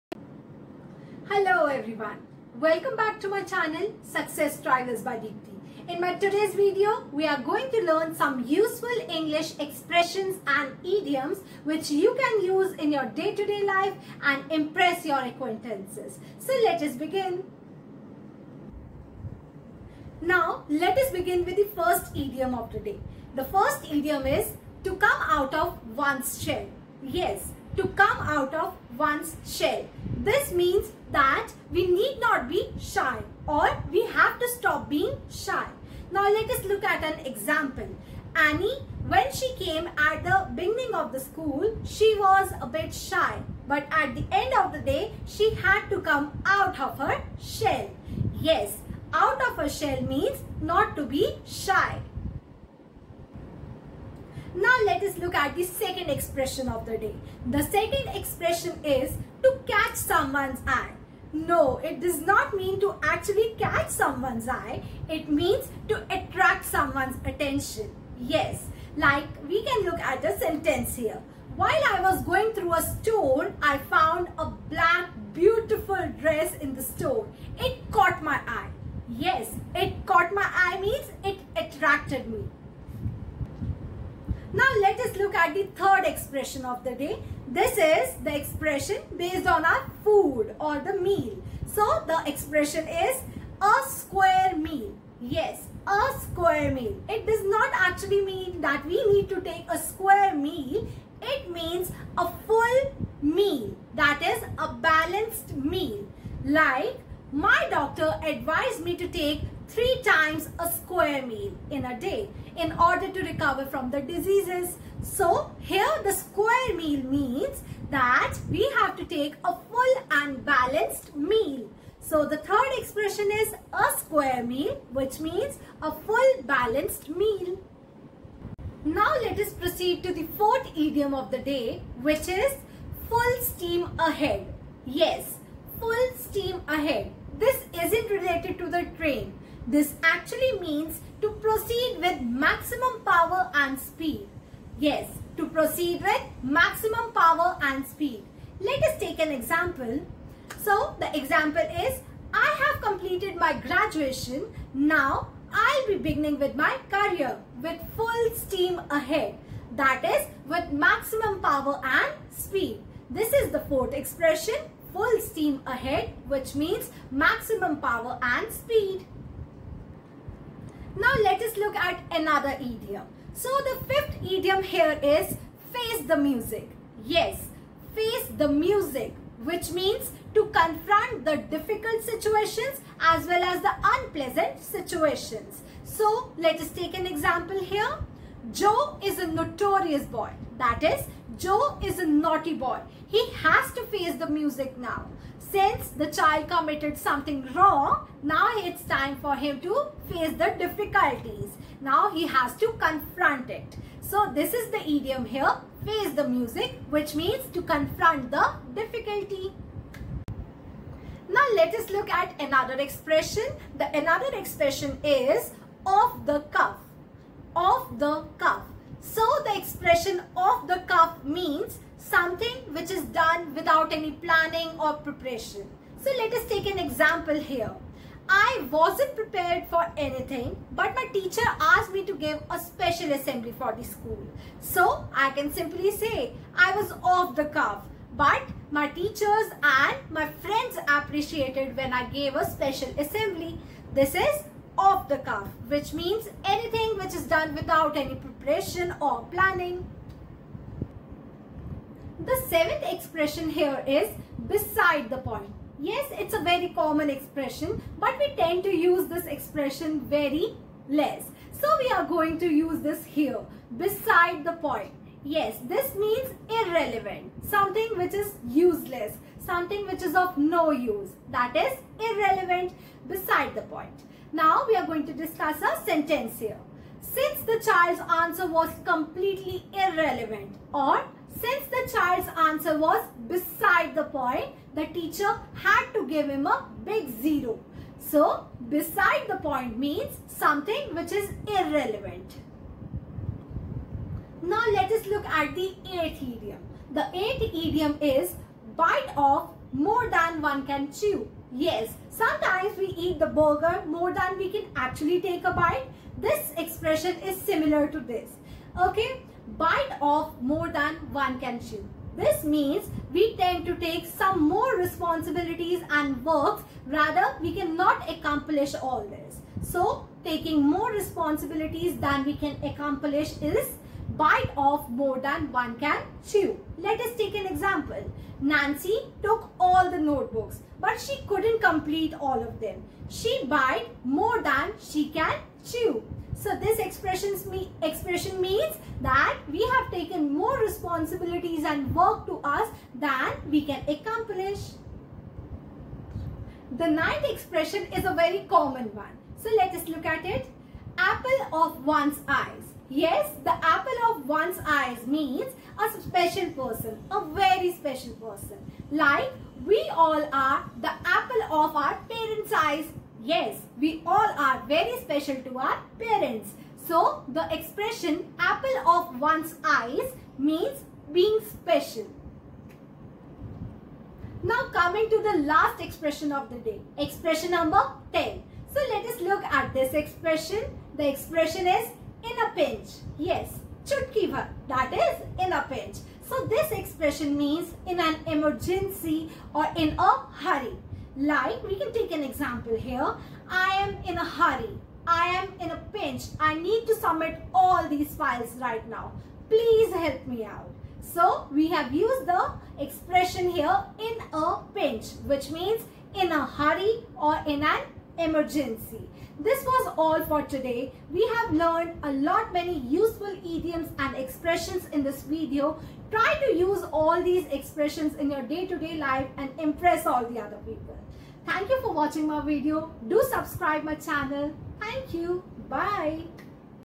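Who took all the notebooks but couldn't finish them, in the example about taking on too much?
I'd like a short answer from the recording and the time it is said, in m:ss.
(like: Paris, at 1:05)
Nancy, at 5:28.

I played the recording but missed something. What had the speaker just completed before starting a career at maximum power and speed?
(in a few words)
graduation.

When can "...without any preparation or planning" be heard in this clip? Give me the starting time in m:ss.
4:07.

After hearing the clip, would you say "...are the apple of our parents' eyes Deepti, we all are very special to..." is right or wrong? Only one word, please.
wrong.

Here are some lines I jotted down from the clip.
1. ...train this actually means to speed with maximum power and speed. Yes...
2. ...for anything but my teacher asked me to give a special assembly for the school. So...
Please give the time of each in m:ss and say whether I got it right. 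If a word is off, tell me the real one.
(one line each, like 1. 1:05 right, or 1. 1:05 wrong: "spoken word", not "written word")
1. 2:18 wrong: "proceed", not "speed"
2. 3:49 right.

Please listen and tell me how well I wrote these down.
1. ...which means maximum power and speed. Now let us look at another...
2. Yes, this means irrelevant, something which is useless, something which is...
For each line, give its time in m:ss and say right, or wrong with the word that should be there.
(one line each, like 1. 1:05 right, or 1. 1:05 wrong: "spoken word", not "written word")
1. 2:46 right
2. 4:25 right.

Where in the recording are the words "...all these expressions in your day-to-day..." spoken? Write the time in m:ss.
6:56.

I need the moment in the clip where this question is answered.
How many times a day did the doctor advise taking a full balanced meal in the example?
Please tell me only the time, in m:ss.
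1:49.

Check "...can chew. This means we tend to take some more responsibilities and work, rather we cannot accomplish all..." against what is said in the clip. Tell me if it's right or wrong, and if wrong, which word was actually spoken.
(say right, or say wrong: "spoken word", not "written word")
right.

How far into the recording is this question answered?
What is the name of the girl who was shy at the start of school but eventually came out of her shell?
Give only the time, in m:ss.
0:38.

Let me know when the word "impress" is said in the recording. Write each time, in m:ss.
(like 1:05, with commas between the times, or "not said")
0:14, 6:59.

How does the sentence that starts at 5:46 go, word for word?
The ninth expression is a very common one.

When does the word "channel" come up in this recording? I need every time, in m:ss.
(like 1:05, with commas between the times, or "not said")
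0:03, 7:04.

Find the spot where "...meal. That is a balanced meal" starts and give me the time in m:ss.
1:43.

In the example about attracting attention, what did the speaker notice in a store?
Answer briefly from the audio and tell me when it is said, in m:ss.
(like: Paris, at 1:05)
black beautiful dress, at 1:14.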